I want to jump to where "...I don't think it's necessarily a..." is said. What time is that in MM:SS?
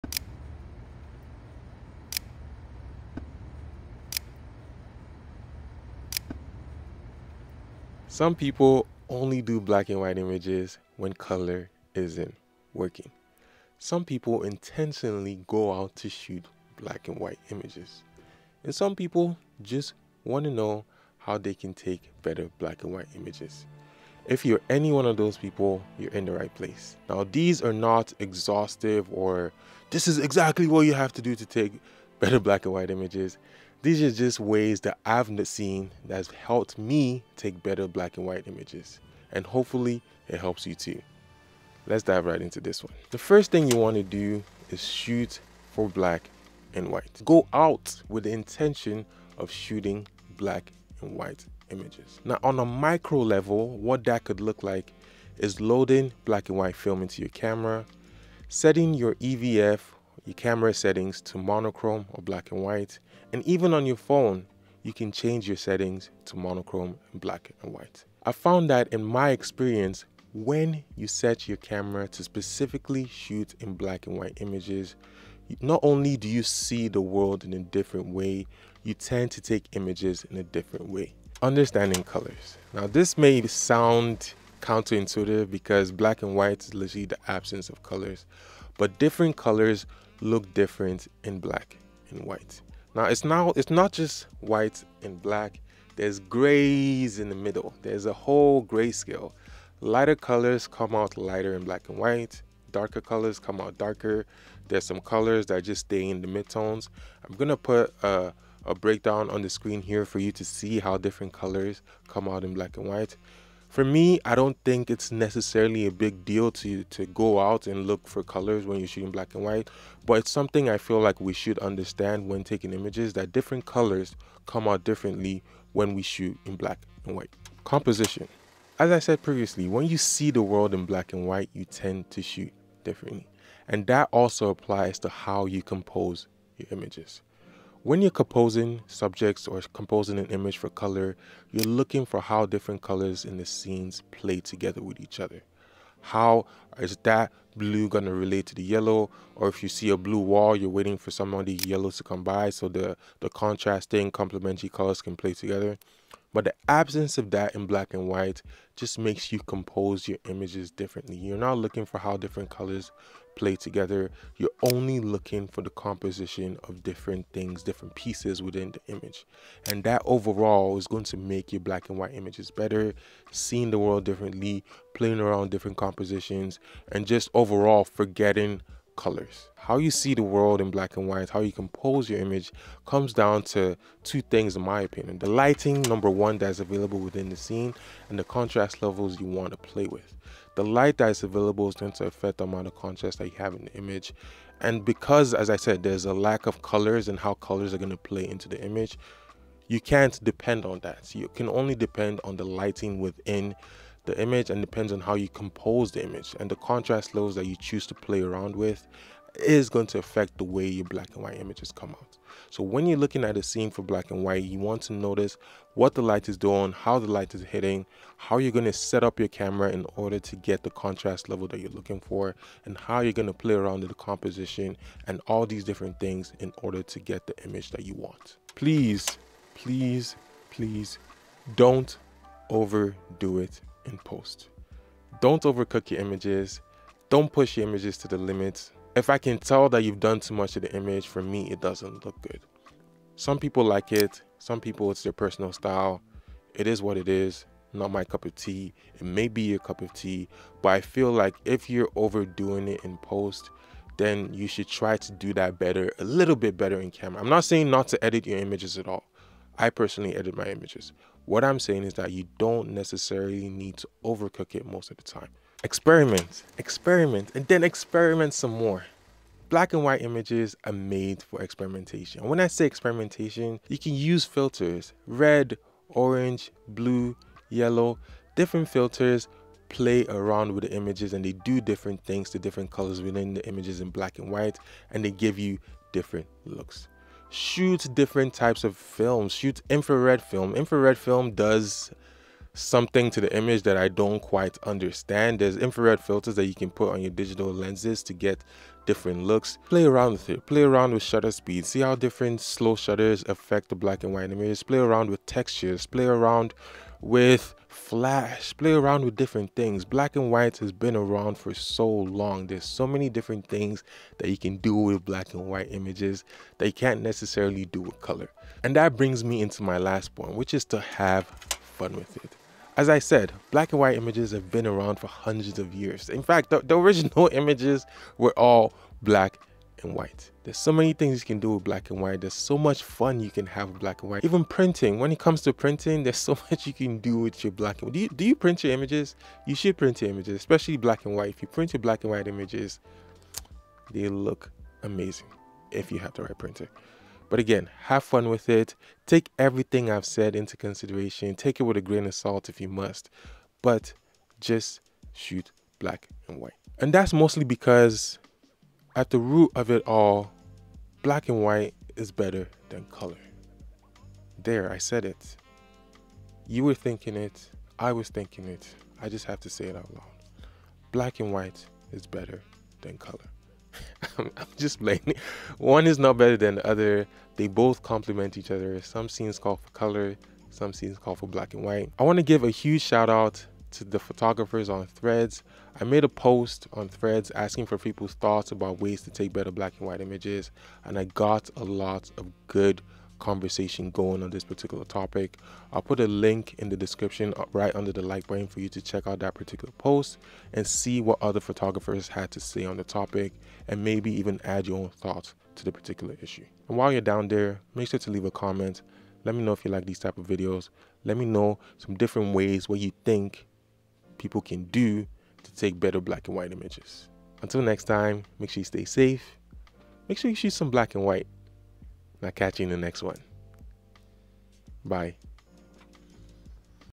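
01:54.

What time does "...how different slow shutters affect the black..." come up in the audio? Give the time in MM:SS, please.
05:01.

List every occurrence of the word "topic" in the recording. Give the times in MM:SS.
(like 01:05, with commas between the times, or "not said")
06:34, 06:42.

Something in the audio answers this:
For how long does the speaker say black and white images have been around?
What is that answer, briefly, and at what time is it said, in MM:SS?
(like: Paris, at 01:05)
hundreds of years, at 05:25.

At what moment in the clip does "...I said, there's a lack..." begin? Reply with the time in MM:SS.
03:15.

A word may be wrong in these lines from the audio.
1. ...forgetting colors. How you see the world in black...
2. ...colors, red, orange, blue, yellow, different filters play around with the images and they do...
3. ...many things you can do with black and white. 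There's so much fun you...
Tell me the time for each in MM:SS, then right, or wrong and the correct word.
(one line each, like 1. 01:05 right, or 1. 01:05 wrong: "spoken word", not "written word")
1. 02:57 right
2. 04:34 wrong: "filters", not "colors"
3. 05:30 right.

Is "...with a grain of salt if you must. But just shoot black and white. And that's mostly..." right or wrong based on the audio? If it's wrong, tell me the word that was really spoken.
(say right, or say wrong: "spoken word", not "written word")
right.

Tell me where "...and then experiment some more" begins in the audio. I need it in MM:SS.
04:27.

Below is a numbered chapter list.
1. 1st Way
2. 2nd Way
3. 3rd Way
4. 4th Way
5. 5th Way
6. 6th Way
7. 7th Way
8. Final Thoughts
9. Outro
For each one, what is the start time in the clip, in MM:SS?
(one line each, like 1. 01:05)
1. 00:43
2. 01:21
3. 02:07
4. 03:04
5. 03:48
6. 04:25
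7. 05:20
8. 05:57
9. 06:47.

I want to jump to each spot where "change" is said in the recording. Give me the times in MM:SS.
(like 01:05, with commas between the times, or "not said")
01:05.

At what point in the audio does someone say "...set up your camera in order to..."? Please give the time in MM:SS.
03:38.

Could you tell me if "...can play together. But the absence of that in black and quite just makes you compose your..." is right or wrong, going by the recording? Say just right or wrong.
wrong.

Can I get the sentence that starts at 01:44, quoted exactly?
There's some colors that just stay in the midtones.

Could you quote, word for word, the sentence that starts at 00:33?
These are just ways that I've seen that's helped me take better black and white images.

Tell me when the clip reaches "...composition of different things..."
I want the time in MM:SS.
02:45.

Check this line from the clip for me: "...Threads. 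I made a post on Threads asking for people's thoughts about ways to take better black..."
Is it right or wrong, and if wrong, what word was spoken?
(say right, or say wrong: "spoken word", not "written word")
right.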